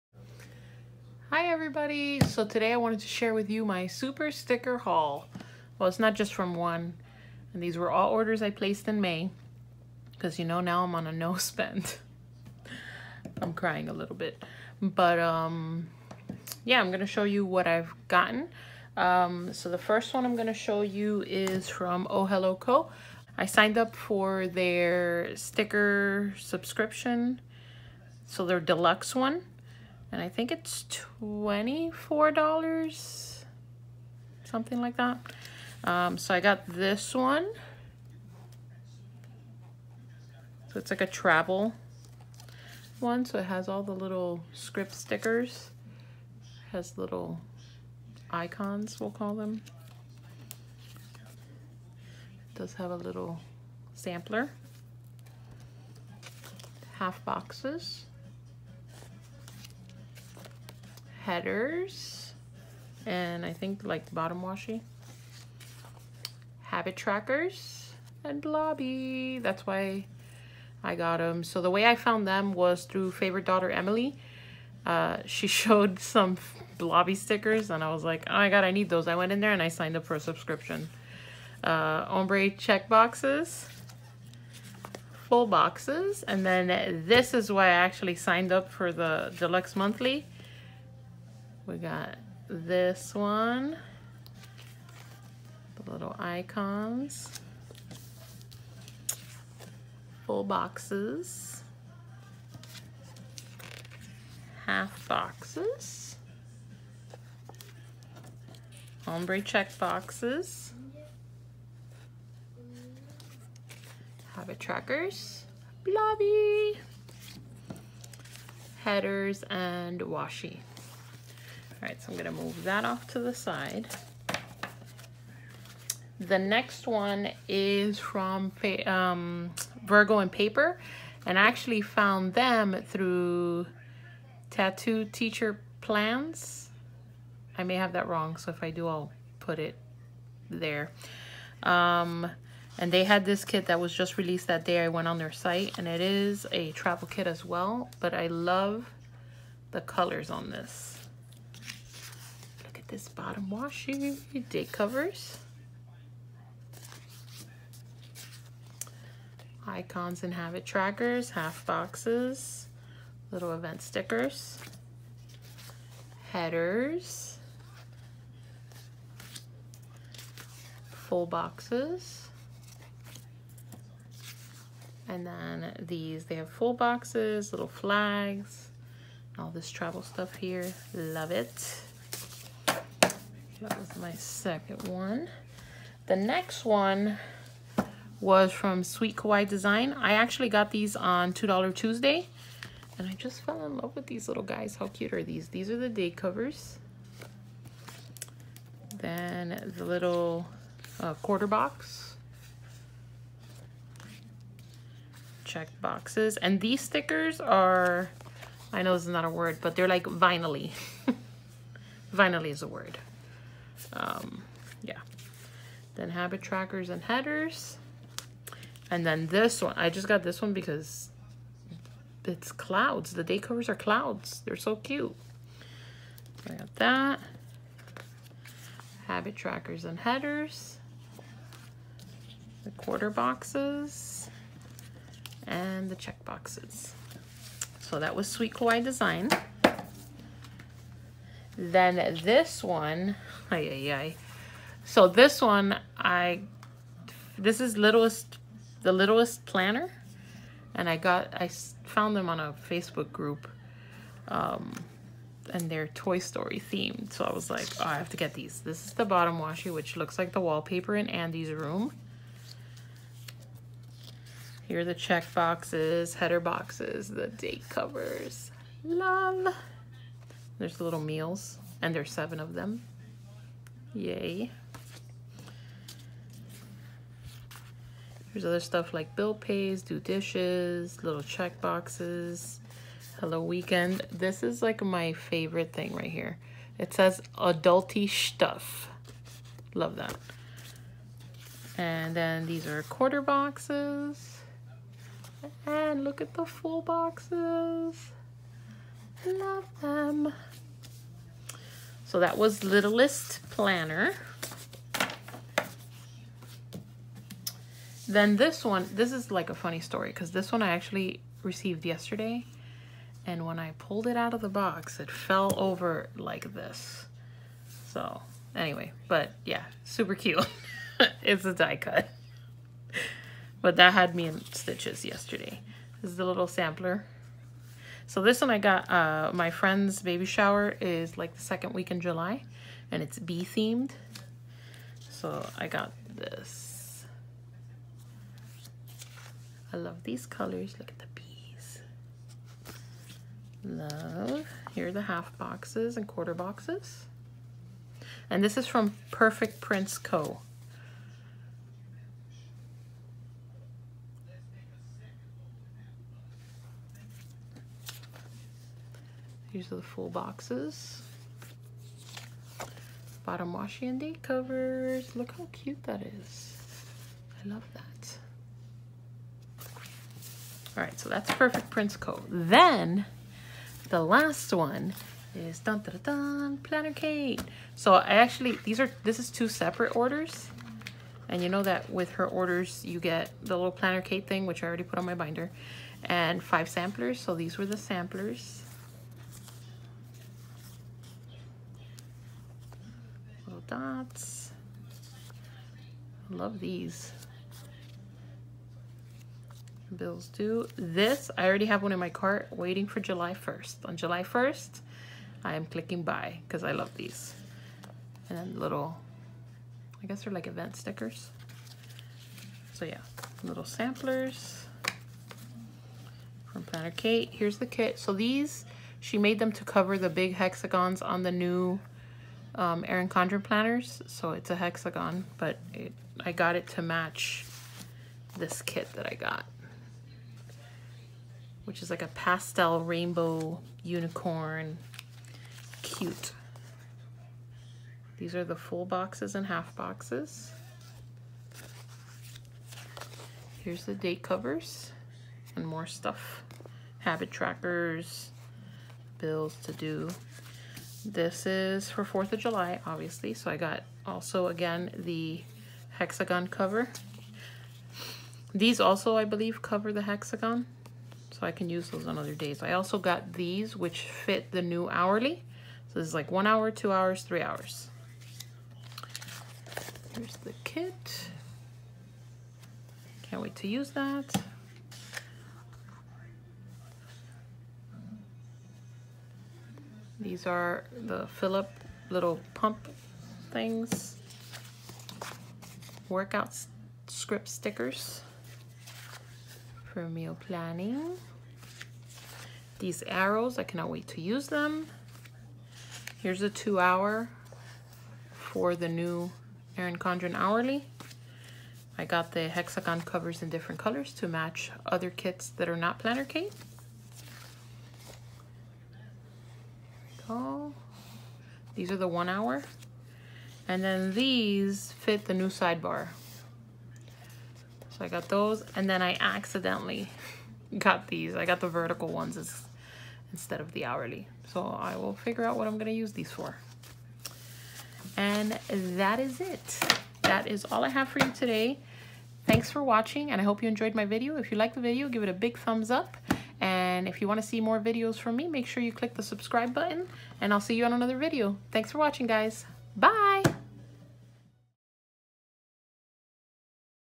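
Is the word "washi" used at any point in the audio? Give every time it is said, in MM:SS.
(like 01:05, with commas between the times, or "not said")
01:04, 02:00, 02:33, 04:19, 06:03.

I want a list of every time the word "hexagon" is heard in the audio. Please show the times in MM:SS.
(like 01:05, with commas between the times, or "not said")
07:00, 07:04, 07:35, 07:40, 08:22.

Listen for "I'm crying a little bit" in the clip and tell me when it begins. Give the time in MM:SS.
00:13.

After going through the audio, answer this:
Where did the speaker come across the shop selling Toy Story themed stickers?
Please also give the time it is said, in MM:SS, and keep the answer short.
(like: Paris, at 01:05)
A Facebook group, at 04:12.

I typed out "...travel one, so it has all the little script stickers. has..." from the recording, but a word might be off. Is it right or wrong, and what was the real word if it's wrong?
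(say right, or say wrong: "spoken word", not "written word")
right.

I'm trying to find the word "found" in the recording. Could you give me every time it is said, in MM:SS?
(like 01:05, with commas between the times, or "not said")
01:11, 02:11, 04:11.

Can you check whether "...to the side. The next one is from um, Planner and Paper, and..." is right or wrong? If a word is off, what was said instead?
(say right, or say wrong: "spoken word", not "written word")
wrong: "Virgo", not "Planner".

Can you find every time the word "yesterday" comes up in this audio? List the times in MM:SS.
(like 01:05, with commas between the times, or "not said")
05:11, 05:25.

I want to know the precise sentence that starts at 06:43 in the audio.
On July 1st, I am clicking buy because I love these.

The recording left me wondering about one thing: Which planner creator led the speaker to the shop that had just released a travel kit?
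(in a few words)
Tattooed Teacher Plans.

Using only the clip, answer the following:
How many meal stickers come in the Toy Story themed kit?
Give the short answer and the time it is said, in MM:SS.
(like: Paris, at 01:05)
7, at 04:32.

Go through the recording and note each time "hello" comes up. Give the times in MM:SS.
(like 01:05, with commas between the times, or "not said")
00:22, 04:43.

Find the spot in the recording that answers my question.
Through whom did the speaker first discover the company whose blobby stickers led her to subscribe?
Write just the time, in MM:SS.
01:13.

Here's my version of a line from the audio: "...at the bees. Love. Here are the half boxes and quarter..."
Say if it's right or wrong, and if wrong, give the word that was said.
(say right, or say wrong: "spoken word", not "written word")
right.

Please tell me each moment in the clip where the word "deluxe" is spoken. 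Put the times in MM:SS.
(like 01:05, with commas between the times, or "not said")
00:28, 01:29.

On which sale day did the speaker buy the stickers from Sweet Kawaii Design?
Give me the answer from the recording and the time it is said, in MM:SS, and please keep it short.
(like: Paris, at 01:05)
$2 Tuesday, at 03:11.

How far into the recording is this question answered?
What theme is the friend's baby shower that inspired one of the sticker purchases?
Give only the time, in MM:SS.
05:33.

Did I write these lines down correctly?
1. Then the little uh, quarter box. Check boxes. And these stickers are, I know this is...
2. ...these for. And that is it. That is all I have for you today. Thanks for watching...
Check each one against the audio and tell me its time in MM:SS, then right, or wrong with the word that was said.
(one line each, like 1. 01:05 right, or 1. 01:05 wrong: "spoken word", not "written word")
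1. 03:18 right
2. 08:46 right.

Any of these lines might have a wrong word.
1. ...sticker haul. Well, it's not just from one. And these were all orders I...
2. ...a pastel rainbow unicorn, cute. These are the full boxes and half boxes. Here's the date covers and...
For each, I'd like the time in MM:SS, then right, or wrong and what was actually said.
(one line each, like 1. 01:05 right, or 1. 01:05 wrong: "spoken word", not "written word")
1. 00:04 right
2. 07:12 right.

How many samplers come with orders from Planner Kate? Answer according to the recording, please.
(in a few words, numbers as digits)
5.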